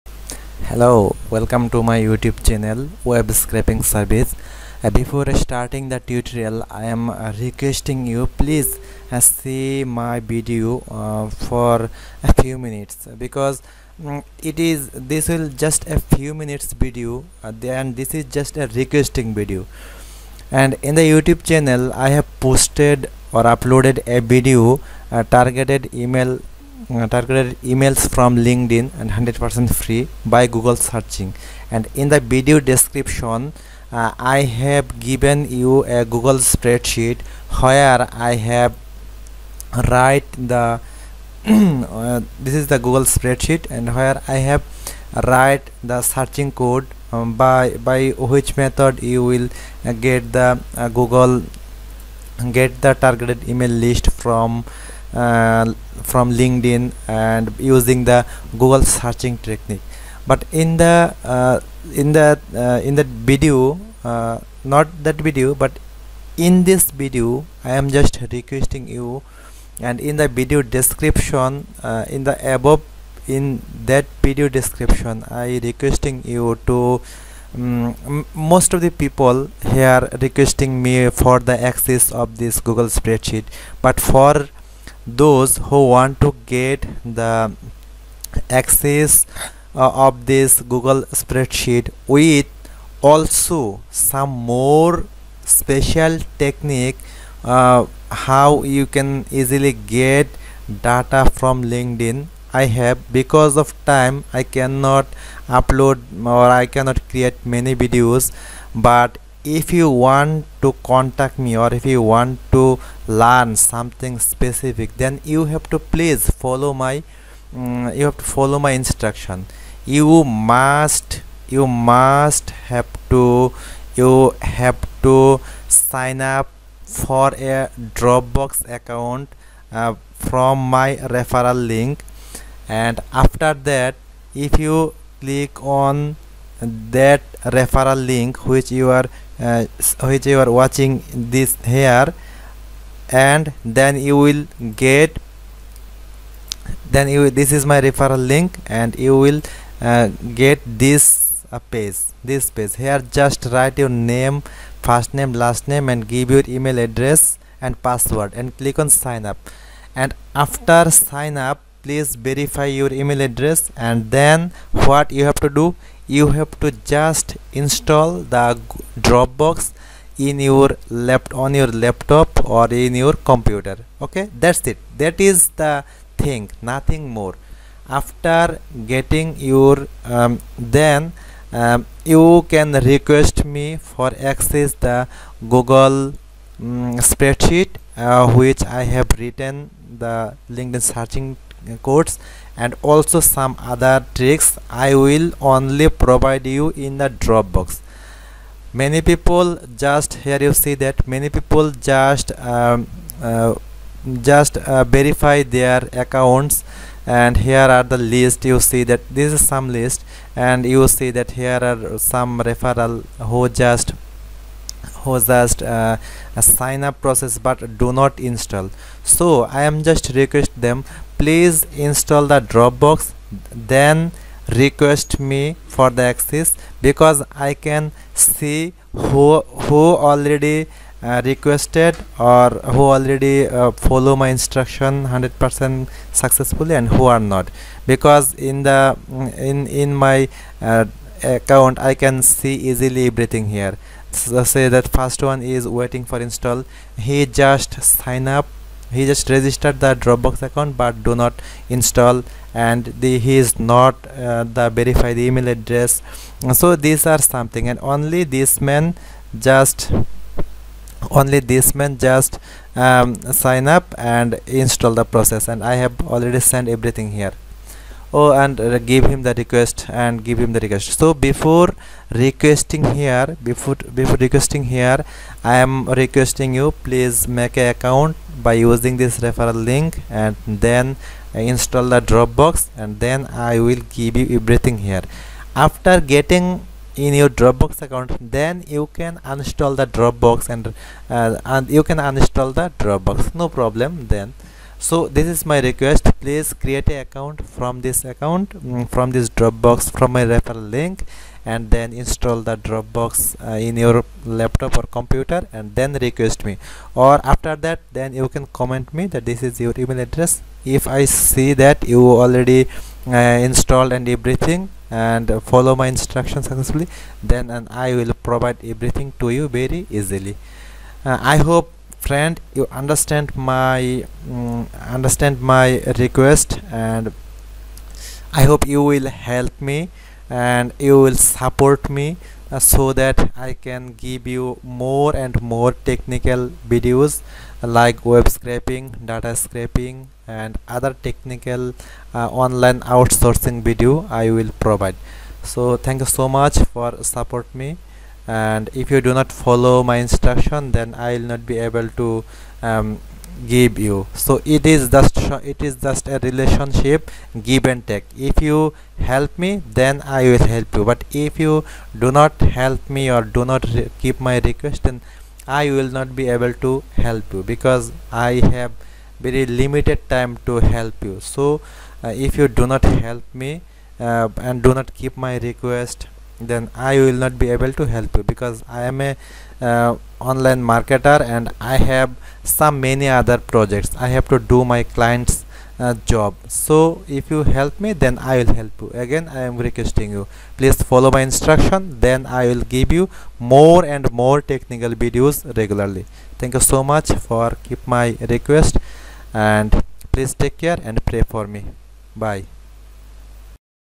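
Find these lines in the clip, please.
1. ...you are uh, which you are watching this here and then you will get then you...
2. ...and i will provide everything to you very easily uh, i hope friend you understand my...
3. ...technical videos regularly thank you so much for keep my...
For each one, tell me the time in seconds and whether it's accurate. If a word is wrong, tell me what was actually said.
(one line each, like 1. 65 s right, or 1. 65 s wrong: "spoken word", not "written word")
1. 138 s right
2. 317 s right
3. 394 s right.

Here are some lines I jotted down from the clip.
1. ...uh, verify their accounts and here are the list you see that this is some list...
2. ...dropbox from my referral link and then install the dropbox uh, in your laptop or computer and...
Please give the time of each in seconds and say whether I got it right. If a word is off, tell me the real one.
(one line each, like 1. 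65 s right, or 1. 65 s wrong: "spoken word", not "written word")
1. 204 s right
2. 299 s right.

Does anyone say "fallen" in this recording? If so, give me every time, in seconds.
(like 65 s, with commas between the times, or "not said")
not said.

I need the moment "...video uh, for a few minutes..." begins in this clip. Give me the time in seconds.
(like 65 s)
10 s.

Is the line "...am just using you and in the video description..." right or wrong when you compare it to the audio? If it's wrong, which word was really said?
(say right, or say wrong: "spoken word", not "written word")
wrong: "requesting", not "using".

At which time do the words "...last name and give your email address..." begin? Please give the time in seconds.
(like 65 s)
155 s.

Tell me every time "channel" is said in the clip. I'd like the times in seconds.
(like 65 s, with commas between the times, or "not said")
2 s, 21 s.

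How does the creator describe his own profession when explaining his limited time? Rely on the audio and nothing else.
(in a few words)
online marketer.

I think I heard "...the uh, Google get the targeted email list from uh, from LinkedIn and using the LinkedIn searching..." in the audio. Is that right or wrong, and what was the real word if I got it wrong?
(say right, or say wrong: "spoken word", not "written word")
wrong: "Google", not "LinkedIn".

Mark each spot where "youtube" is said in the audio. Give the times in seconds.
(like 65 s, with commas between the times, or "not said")
1 s, 21 s.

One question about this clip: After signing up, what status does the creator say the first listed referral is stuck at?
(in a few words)
waiting for install.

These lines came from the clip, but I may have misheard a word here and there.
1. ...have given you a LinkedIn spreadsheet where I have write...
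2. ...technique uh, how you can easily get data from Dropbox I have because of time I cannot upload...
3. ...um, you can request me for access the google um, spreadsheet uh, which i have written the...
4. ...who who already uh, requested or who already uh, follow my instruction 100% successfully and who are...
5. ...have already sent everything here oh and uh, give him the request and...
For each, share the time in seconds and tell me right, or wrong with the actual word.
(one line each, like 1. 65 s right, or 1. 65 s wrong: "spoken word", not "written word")
1. 34 s wrong: "Google", not "LinkedIn"
2. 96 s wrong: "LinkedIn", not "Dropbox"
3. 181 s right
4. 229 s right
5. 265 s right.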